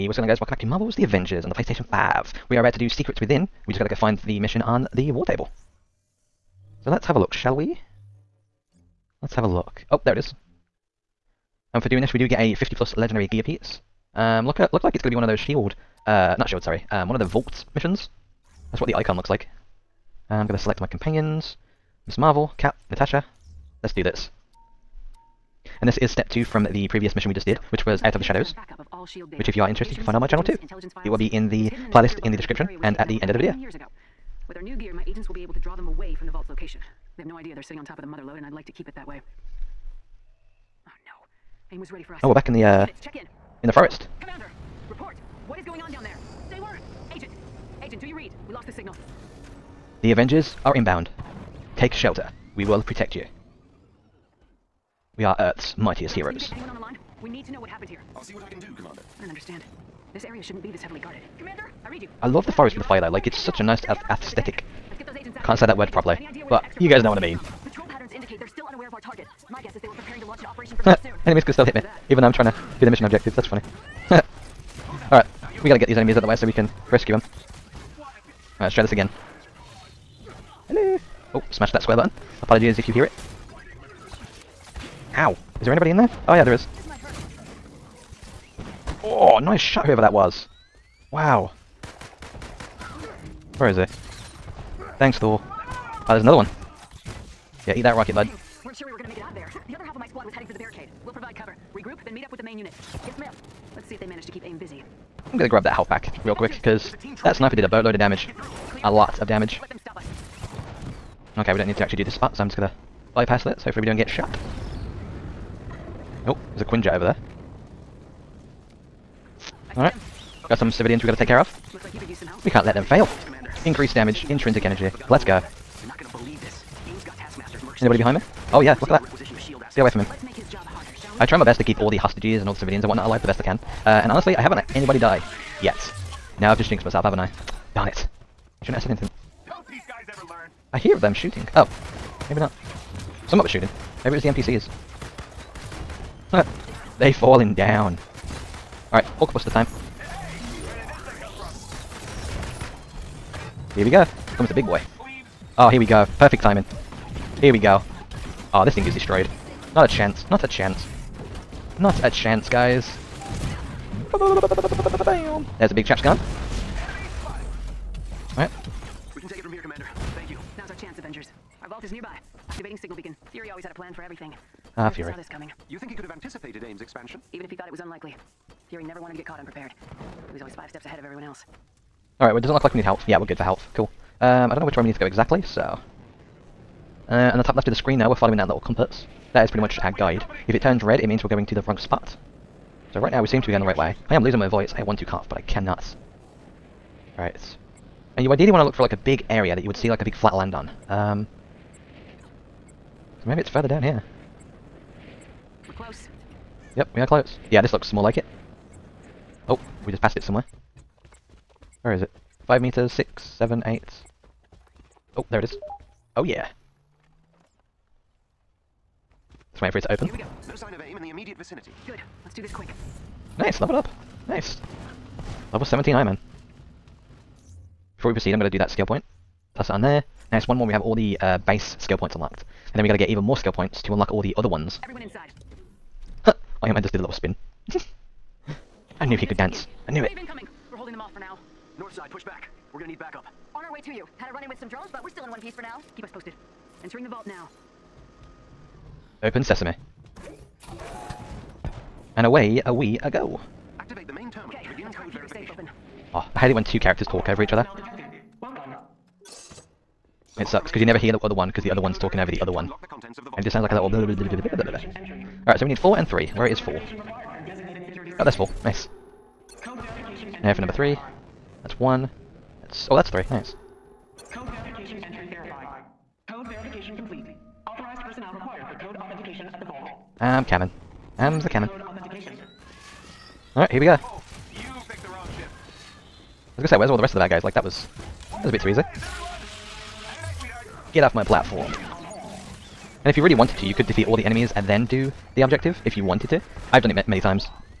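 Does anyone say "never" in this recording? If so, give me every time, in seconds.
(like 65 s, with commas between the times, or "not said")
178 s, 260 s.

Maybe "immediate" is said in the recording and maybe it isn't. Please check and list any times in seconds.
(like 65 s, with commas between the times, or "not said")
221 s.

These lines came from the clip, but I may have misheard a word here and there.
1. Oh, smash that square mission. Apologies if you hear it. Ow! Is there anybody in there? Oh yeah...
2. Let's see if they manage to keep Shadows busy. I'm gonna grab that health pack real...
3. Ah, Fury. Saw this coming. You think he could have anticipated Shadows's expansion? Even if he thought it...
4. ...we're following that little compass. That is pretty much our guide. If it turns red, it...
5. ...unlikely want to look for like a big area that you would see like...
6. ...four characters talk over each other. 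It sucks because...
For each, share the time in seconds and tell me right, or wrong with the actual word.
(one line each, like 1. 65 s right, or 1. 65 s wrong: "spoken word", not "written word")
1. 81 s wrong: "button", not "mission"
2. 103 s wrong: "AIM", not "Shadows"
3. 174 s wrong: "AIM", not "Shadows"
4. 188 s right
5. 198 s wrong: "ideally", not "unlikely"
6. 256 s wrong: "two", not "four".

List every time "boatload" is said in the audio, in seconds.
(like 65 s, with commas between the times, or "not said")
107 s.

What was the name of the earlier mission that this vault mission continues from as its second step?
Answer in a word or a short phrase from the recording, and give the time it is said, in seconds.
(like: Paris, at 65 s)
Out of the Shadows, at 28 s.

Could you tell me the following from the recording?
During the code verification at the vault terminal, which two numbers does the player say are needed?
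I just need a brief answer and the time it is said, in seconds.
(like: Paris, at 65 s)
4 and 3, at 265 s.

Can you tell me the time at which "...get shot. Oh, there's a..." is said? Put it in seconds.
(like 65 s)
113 s.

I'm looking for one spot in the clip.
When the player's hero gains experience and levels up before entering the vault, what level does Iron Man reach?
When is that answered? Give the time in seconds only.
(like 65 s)
225 s.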